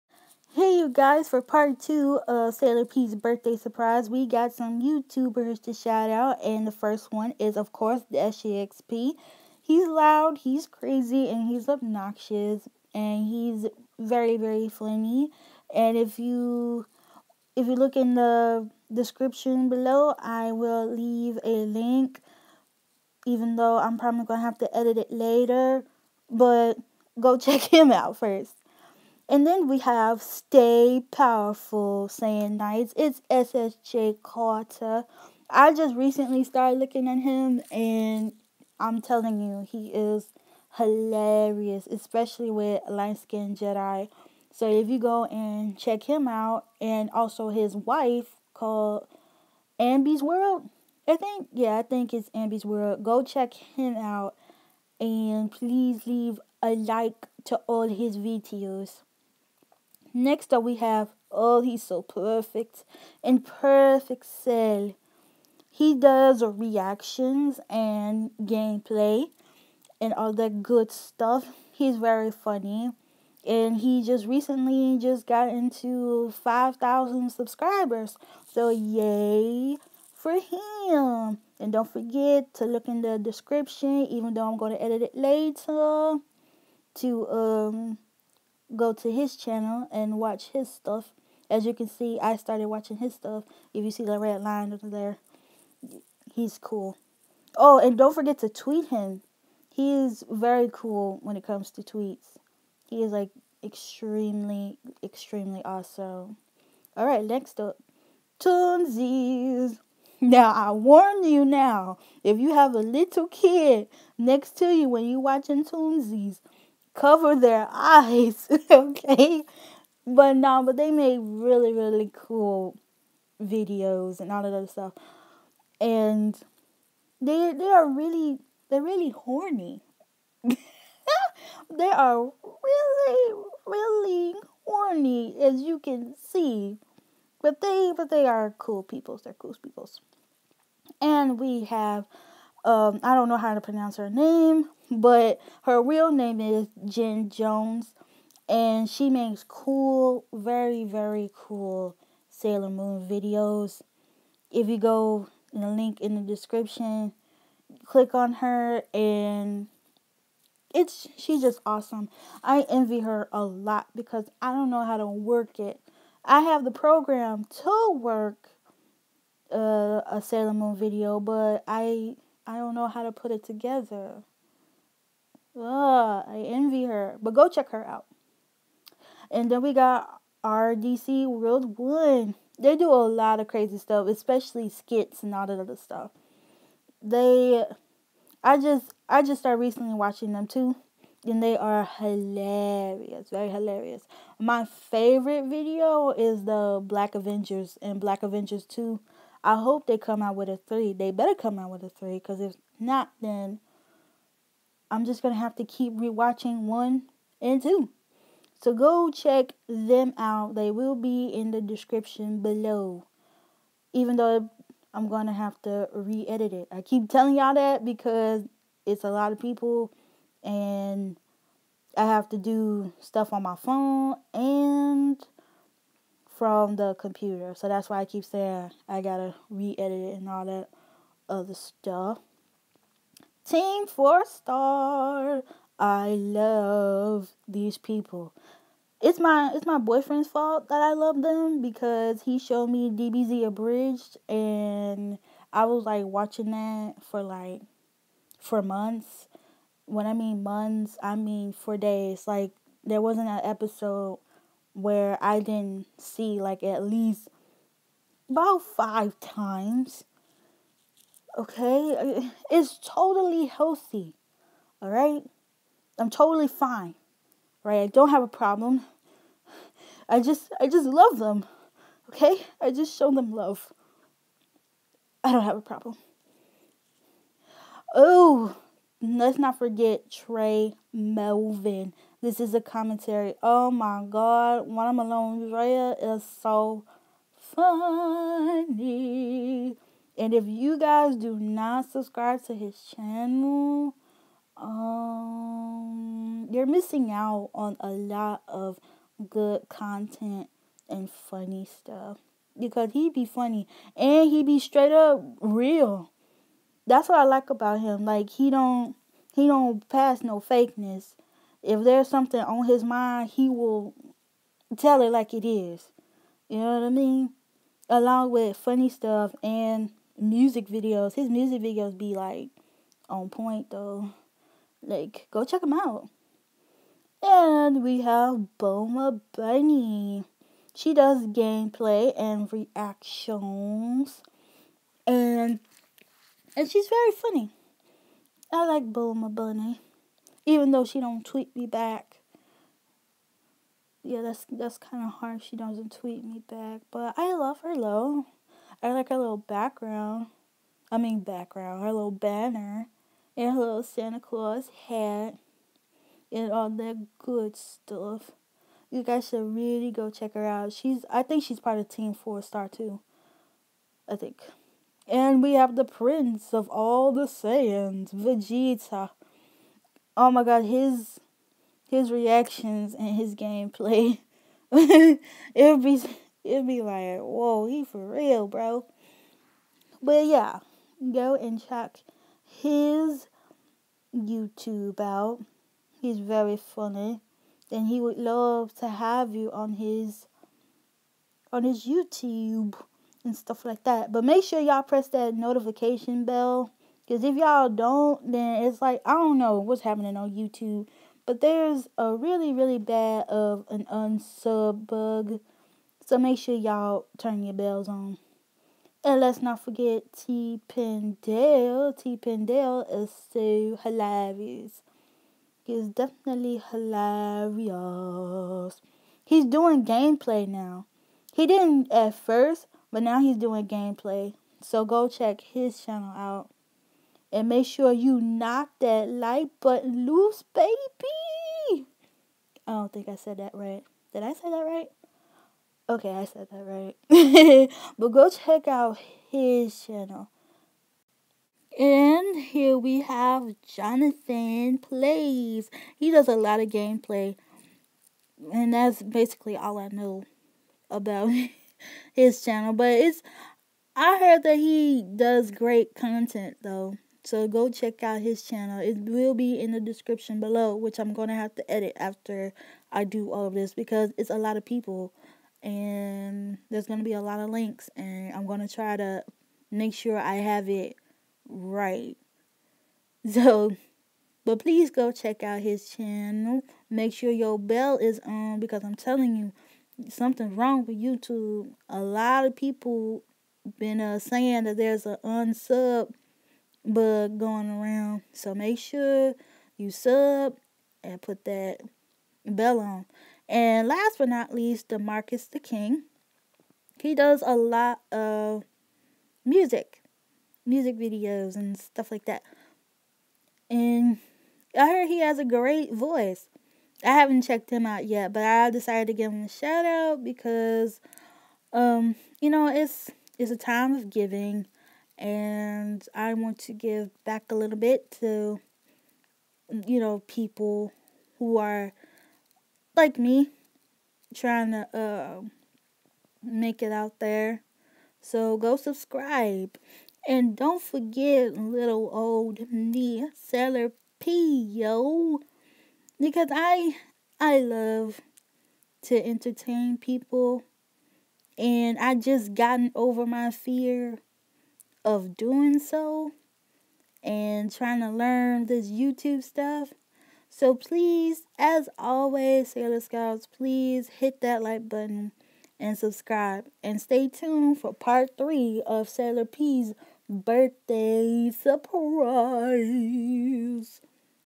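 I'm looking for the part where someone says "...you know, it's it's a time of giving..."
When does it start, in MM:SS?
08:32.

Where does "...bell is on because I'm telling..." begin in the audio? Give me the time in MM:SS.
07:57.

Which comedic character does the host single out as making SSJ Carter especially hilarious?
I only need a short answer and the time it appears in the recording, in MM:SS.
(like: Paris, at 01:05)
Light Skin Jedi, at 00:42.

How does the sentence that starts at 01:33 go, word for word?
If you see the red line over there, he's cool.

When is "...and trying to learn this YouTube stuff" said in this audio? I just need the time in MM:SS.
09:07.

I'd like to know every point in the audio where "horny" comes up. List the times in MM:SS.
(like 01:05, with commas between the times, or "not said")
02:09, 02:14.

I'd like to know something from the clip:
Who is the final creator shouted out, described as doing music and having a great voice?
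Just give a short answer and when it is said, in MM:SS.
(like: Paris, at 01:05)
Demarcus the King, at 08:14.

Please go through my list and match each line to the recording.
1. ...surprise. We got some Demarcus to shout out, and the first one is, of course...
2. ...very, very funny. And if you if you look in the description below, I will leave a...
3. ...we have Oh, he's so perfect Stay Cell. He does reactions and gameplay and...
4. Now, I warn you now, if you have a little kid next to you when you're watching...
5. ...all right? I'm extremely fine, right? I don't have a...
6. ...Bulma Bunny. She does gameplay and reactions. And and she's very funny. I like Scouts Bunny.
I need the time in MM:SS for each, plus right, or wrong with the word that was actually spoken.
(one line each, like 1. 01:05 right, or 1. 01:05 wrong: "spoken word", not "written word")
1. 00:03 wrong: "YouTubers", not "Demarcus"
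2. 00:13 right
3. 01:00 wrong: "Imperfect", not "Stay"
4. 01:50 right
5. 04:24 wrong: "totally", not "extremely"
6. 05:28 wrong: "Bulma", not "Scouts".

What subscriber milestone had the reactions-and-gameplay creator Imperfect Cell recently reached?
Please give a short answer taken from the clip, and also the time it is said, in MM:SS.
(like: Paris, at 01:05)
5,000, at 01:16.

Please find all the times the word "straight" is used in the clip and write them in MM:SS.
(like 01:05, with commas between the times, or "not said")
05:04.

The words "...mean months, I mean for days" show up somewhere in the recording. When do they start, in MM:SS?
04:10.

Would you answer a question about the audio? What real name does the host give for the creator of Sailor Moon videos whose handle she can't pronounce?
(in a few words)
Jen Jones.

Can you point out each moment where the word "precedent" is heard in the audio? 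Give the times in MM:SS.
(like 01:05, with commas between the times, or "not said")
not said.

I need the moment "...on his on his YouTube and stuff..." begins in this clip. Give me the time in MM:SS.
06:29.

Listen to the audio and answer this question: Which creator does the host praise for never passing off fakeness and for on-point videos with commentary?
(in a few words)
Tré Melvin.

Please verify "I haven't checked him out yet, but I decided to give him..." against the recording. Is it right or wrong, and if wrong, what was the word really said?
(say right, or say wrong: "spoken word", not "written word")
right.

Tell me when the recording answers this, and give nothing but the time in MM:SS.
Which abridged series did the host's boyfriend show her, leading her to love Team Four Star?
04:02.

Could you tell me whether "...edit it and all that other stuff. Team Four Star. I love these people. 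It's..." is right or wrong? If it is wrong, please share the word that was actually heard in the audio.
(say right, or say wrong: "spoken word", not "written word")
right.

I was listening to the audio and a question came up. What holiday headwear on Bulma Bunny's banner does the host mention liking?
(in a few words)
Santa Claus hat.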